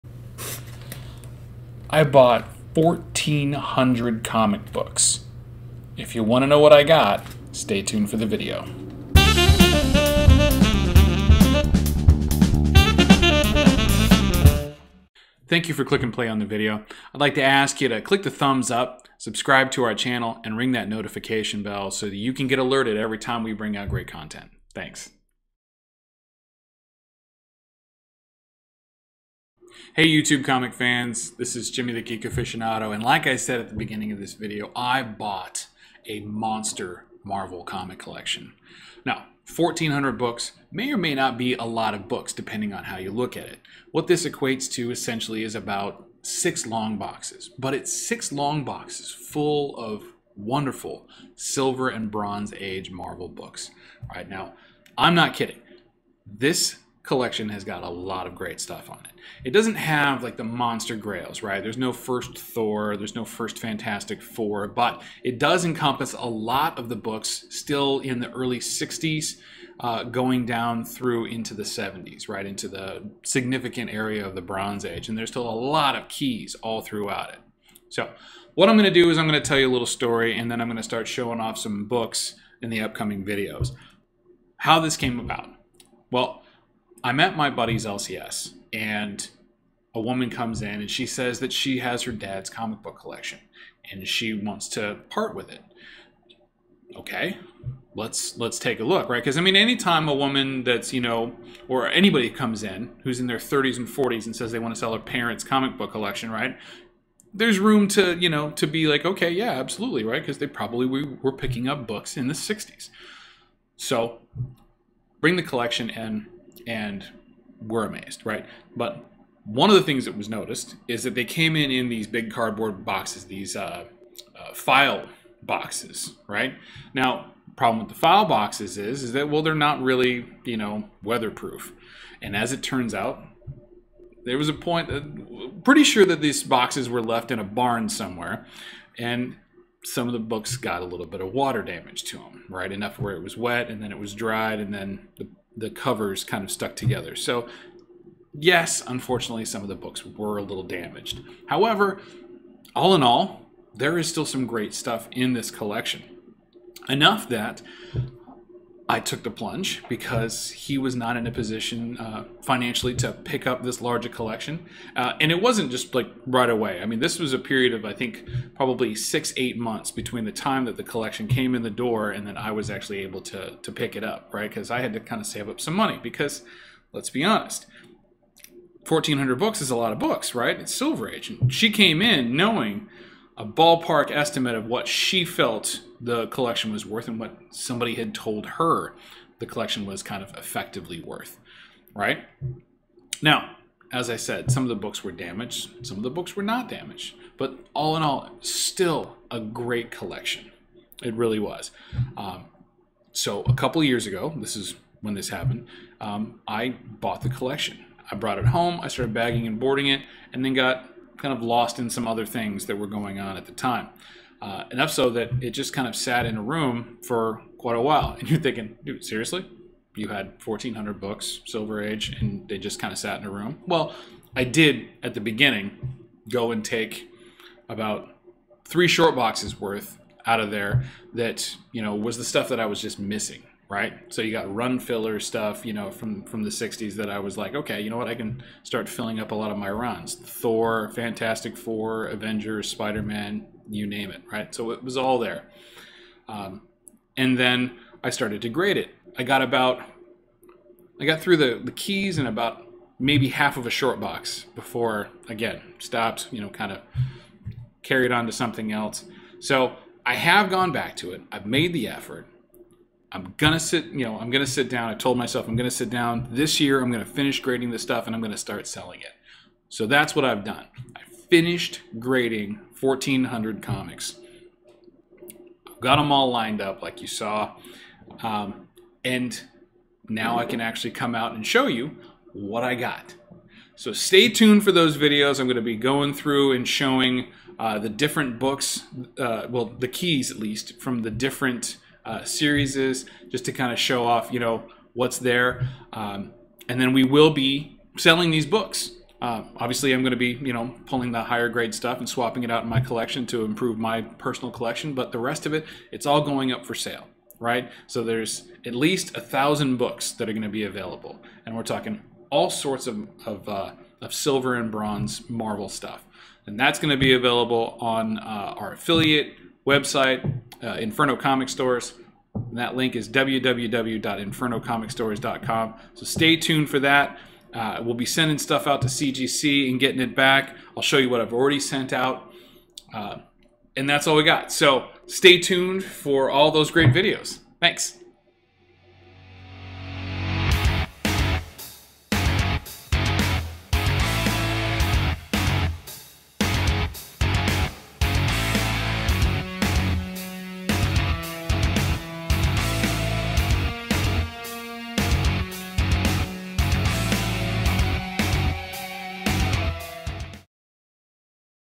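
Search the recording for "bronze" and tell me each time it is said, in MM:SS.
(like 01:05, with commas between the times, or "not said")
00:52, 01:14, 05:14.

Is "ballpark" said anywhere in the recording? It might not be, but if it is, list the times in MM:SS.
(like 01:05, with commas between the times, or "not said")
03:03.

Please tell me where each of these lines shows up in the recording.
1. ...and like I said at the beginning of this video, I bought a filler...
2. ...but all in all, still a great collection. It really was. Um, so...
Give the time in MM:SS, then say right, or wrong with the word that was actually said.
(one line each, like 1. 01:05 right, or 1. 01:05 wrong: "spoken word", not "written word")
1. 00:32 wrong: "monster", not "filler"
2. 03:17 right.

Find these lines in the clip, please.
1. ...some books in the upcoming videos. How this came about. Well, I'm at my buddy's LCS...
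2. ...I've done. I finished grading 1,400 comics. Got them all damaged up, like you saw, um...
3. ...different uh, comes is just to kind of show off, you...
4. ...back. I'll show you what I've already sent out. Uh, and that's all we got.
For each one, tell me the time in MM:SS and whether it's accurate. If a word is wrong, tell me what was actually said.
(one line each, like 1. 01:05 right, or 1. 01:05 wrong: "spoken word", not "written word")
1. 01:21 right
2. 04:30 wrong: "lined", not "damaged"
3. 04:51 wrong: "series", not "comes"
4. 05:30 right.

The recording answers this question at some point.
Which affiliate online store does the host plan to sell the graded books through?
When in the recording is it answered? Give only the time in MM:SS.
05:20.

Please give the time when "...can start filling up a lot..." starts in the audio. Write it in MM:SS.
03:58.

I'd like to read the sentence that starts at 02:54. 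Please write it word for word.
Because I had to kind of save up some money because, let's be honest, 1,400 books is a lot of books, right?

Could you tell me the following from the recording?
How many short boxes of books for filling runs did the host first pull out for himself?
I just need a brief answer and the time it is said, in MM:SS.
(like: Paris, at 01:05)
3, at 03:48.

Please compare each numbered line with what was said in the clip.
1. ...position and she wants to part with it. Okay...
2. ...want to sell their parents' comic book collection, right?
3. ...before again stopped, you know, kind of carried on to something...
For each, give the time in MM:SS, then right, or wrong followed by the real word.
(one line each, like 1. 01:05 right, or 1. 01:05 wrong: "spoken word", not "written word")
1. 01:32 wrong: "collection", not "position"
2. 01:44 right
3. 04:14 right.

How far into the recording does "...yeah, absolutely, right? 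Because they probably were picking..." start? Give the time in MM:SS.
01:49.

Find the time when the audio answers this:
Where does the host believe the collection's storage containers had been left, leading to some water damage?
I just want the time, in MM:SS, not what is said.
02:17.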